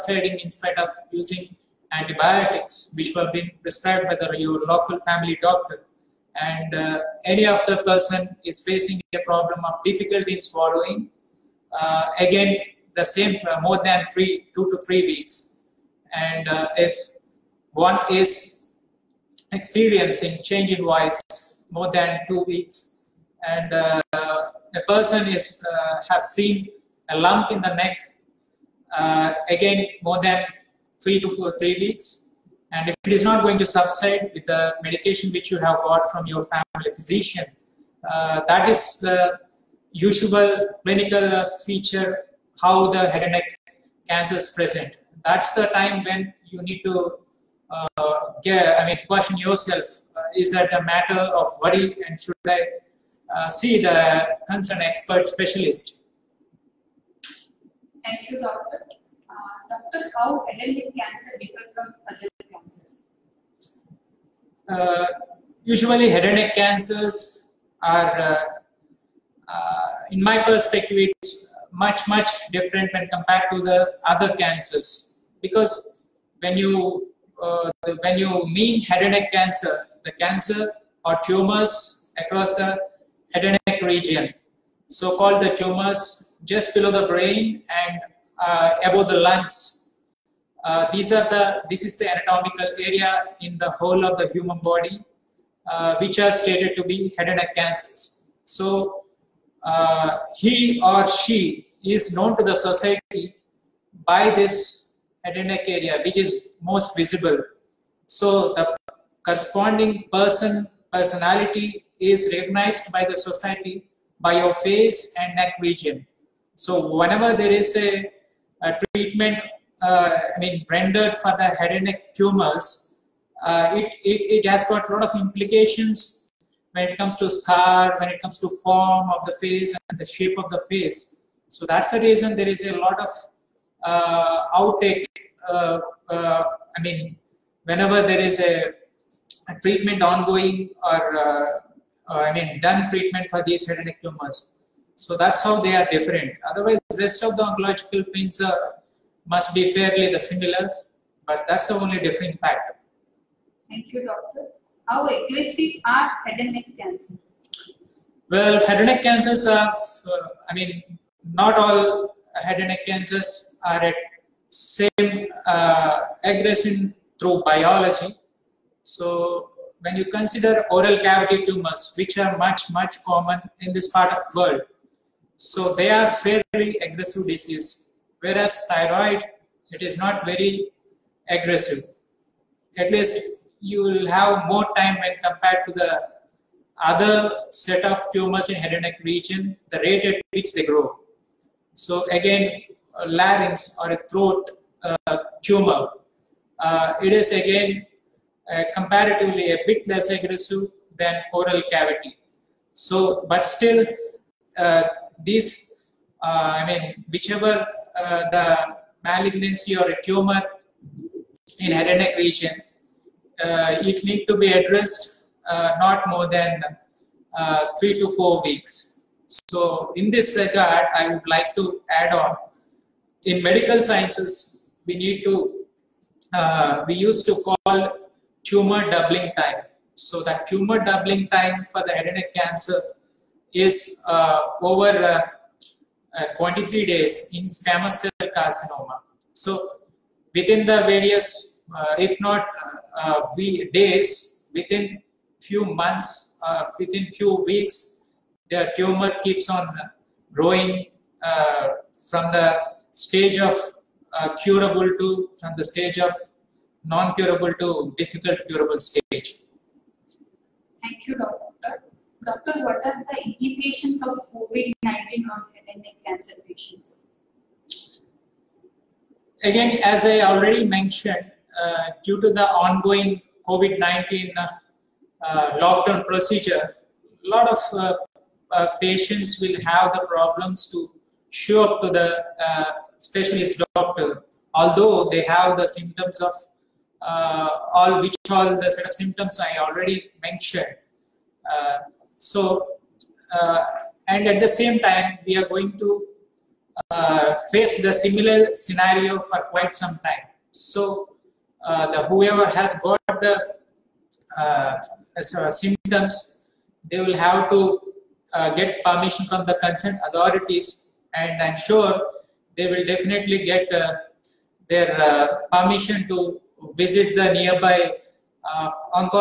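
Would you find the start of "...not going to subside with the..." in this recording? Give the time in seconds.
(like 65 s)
33 s.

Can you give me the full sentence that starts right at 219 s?
So, in this regard, I would like to add on.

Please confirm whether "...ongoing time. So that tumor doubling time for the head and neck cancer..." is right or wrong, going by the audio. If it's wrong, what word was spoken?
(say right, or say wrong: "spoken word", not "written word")
wrong: "doubling", not "ongoing".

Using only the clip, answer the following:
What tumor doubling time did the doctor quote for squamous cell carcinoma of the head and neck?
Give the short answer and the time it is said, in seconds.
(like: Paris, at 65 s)
23 days, at 236 s.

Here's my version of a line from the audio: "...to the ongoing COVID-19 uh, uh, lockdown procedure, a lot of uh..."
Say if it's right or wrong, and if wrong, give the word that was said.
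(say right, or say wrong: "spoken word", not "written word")
right.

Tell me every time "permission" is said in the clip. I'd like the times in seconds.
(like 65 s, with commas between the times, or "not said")
308 s, 315 s.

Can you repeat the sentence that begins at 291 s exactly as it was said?
Uh, so, uh, and at the same time, we are going to face the similar scenario for quite some time.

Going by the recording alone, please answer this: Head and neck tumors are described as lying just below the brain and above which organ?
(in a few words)
Lungs.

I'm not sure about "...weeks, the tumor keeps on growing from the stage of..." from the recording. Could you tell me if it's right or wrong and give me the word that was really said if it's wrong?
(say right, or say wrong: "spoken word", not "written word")
right.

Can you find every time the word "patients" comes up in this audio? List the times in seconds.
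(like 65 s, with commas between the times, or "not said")
266 s, 278 s.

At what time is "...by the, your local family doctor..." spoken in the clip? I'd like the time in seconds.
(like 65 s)
4 s.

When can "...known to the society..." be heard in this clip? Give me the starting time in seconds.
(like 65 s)
102 s.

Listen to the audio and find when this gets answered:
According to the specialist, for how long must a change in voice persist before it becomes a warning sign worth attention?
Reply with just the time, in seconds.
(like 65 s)
22 s.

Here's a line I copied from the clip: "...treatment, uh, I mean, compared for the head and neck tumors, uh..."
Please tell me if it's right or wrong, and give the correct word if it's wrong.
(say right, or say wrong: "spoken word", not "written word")
wrong: "rendered", not "compared".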